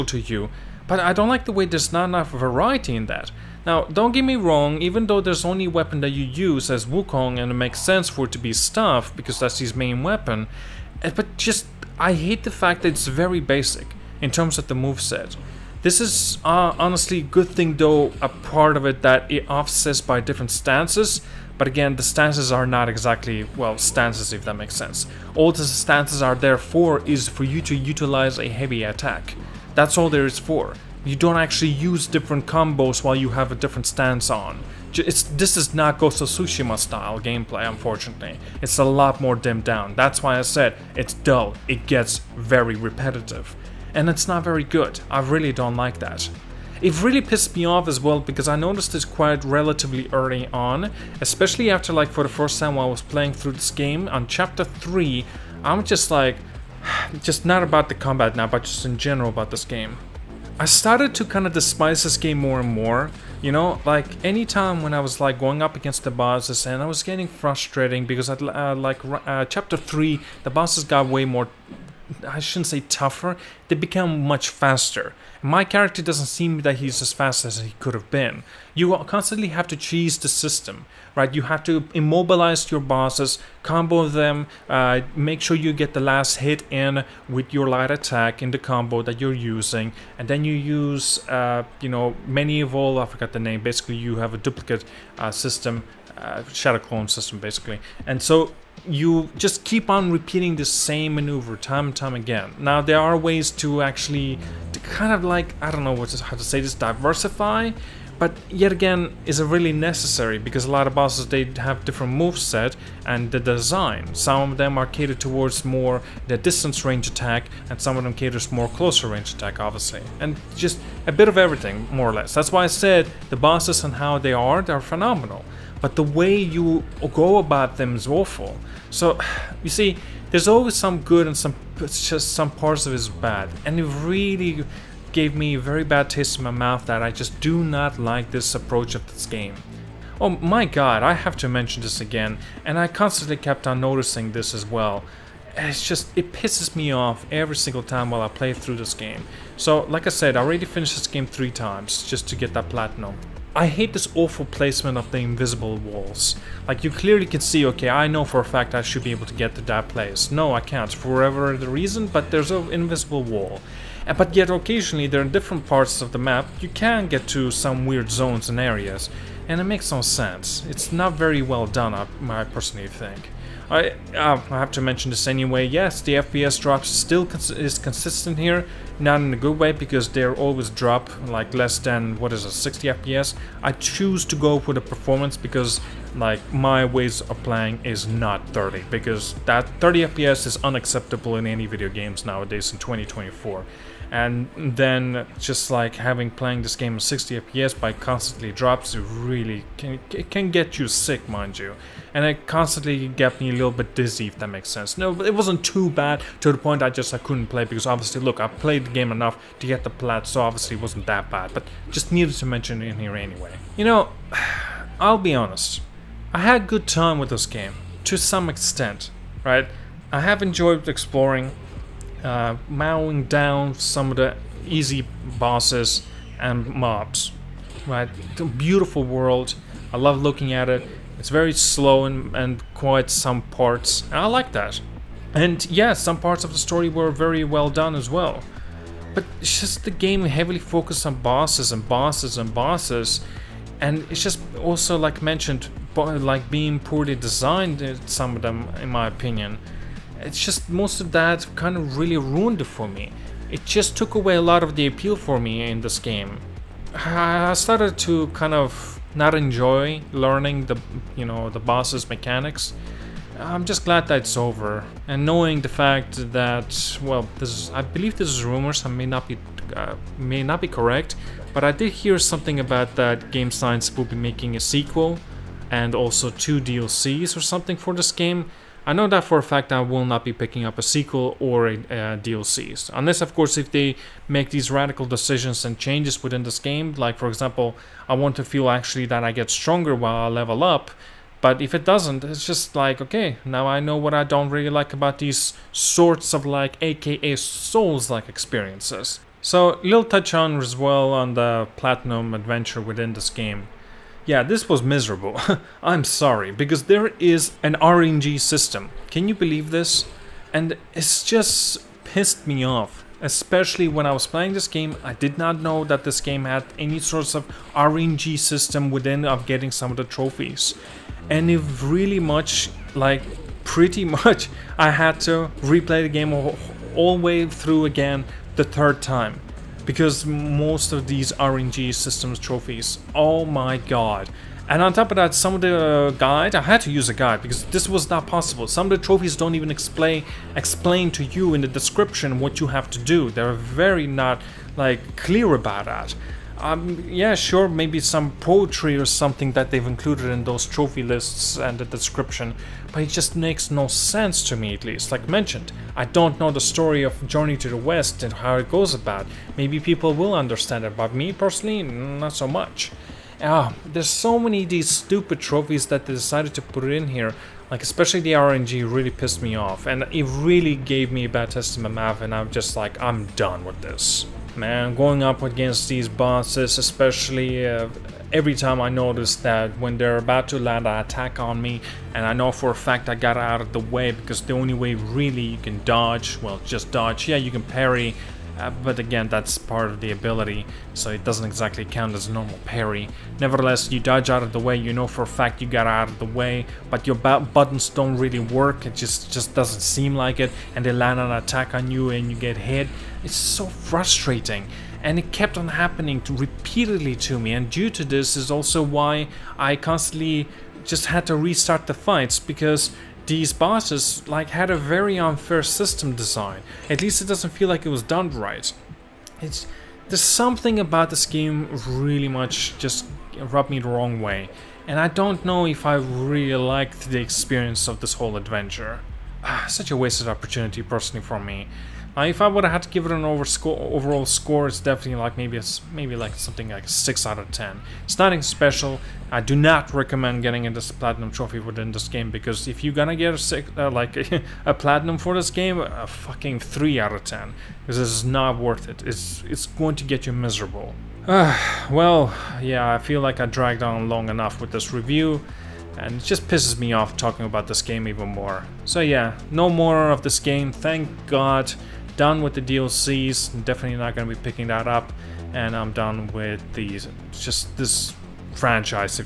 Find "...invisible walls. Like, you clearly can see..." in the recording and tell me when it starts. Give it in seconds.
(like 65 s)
155 s.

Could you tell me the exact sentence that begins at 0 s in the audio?
But I don't like the way there's not enough variety in that.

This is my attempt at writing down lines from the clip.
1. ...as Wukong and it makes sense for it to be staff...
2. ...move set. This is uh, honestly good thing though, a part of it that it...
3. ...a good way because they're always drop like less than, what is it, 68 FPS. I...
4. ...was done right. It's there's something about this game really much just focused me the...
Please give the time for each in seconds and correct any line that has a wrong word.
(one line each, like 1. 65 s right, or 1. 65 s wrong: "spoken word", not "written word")
1. 6 s right
2. 14 s right
3. 179 s wrong: "60", not "68"
4. 417 s wrong: "rubbed", not "focused".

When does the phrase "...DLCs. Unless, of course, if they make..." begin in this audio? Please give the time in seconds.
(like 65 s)
282 s.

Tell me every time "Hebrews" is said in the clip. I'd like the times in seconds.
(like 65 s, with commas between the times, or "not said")
not said.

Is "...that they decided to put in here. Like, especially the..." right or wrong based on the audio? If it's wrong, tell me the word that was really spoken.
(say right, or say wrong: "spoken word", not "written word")
right.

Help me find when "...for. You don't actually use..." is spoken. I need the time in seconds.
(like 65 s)
30 s.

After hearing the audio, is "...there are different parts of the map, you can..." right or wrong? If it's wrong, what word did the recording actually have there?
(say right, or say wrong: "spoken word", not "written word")
right.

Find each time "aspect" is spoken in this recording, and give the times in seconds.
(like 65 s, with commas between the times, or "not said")
not said.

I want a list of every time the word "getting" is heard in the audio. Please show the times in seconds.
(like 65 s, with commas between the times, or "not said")
67 s, 319 s, 440 s.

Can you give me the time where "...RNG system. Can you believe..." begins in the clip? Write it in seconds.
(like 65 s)
307 s.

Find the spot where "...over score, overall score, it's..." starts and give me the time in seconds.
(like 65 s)
433 s.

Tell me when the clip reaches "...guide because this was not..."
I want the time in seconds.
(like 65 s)
337 s.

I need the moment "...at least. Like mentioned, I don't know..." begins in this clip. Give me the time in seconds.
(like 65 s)
354 s.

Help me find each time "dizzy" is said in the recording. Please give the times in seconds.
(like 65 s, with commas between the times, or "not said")
203 s.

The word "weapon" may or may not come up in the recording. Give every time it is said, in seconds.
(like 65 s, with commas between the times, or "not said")
5 s, 10 s.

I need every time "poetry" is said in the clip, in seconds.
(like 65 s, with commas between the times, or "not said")
348 s.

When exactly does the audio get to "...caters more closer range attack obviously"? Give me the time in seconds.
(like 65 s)
118 s.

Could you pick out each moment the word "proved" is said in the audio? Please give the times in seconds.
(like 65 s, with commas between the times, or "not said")
not said.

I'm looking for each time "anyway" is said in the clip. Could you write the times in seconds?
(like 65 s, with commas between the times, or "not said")
175 s, 213 s.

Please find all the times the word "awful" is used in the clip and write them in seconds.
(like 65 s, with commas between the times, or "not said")
128 s, 154 s.